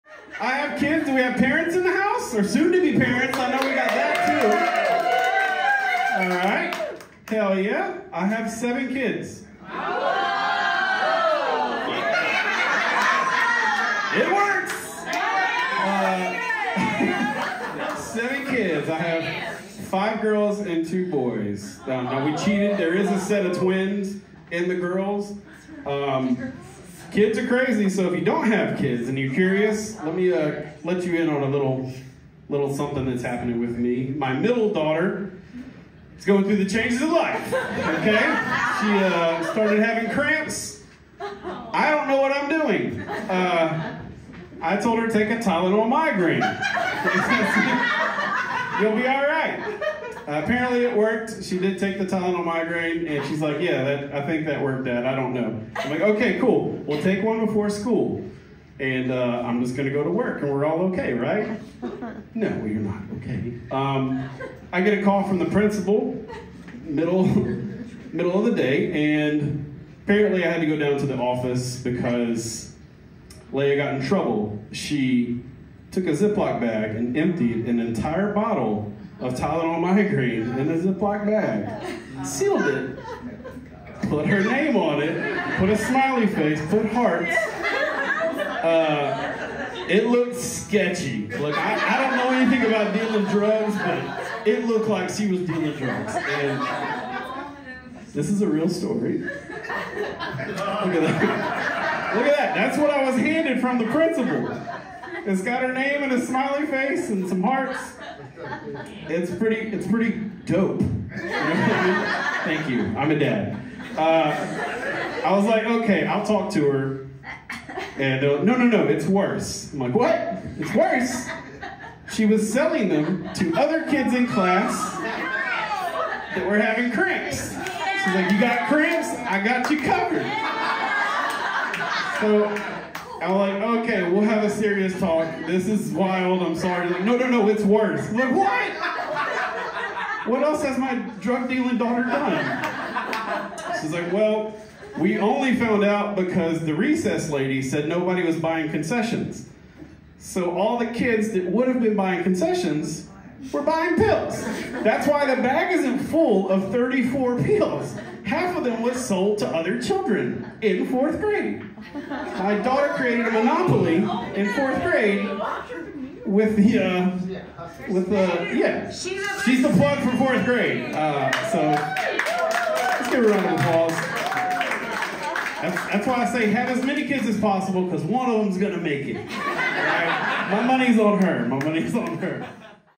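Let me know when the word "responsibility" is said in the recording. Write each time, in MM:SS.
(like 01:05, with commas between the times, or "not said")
not said.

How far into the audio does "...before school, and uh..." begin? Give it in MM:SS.
00:57.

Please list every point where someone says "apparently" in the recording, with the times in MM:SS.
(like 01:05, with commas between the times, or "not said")
00:50, 01:10.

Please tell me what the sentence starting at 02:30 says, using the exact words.
So all the kids that would have been buying concessions were buying pills.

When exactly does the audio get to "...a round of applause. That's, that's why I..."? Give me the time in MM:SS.
02:53.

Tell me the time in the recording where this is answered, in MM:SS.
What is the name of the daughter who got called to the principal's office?
01:13.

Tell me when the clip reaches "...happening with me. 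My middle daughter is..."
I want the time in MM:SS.
00:33.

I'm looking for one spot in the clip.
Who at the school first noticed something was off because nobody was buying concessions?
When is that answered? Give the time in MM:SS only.
02:26.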